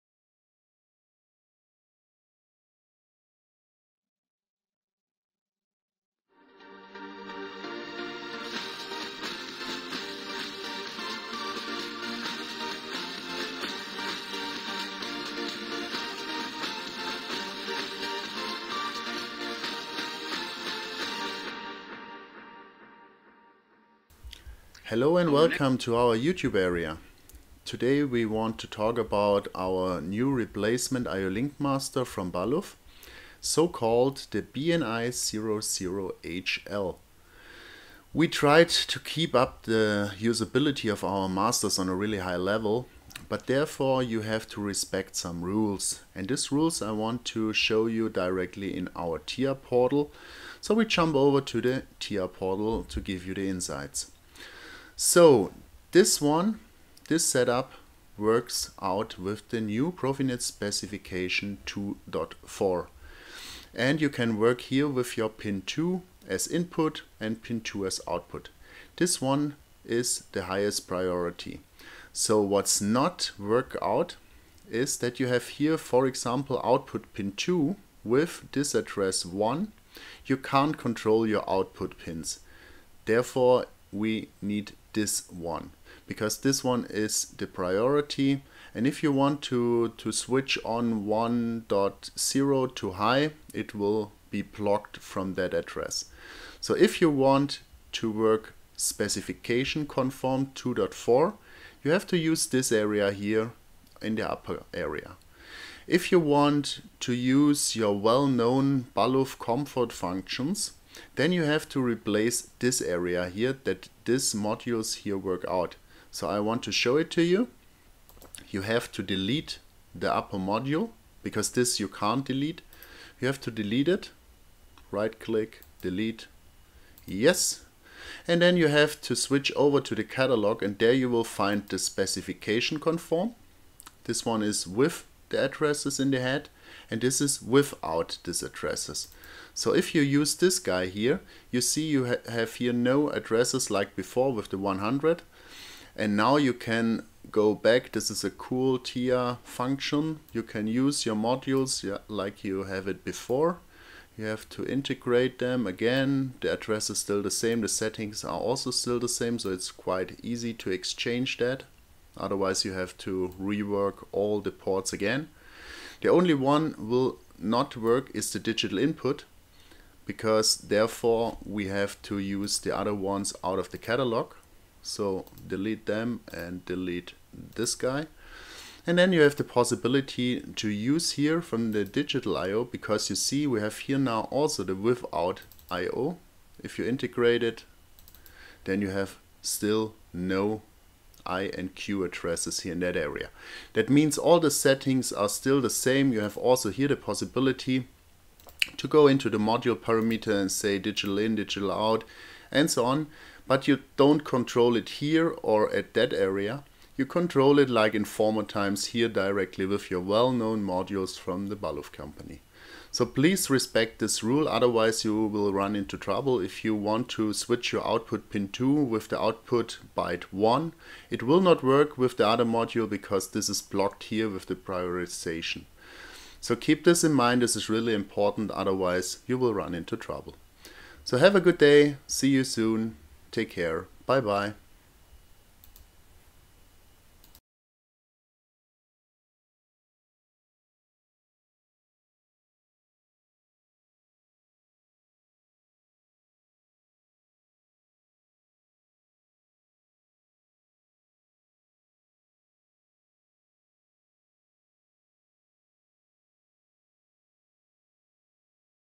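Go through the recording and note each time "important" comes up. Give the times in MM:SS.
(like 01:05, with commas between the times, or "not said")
03:47.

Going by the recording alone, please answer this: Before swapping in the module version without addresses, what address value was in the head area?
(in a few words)
100.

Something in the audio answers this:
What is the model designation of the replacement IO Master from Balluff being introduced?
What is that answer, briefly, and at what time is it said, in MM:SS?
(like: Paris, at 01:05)
BNI00HL, at 00:34.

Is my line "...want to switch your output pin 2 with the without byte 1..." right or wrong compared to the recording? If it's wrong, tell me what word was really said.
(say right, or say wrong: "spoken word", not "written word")
wrong: "output", not "without".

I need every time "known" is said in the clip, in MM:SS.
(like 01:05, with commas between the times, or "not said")
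01:47, 03:30.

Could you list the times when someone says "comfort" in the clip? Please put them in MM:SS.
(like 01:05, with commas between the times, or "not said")
01:49.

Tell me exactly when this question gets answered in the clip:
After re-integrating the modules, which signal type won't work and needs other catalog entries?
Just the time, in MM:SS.
02:48.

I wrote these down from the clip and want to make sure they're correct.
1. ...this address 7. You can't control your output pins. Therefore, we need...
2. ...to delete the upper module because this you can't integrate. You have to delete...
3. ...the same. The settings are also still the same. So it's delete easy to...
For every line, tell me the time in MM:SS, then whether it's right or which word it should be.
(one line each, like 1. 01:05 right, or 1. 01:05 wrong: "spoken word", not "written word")
1. 01:18 wrong: "1", not "7"
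2. 01:58 wrong: "delete", not "integrate"
3. 02:37 wrong: "quite", not "delete".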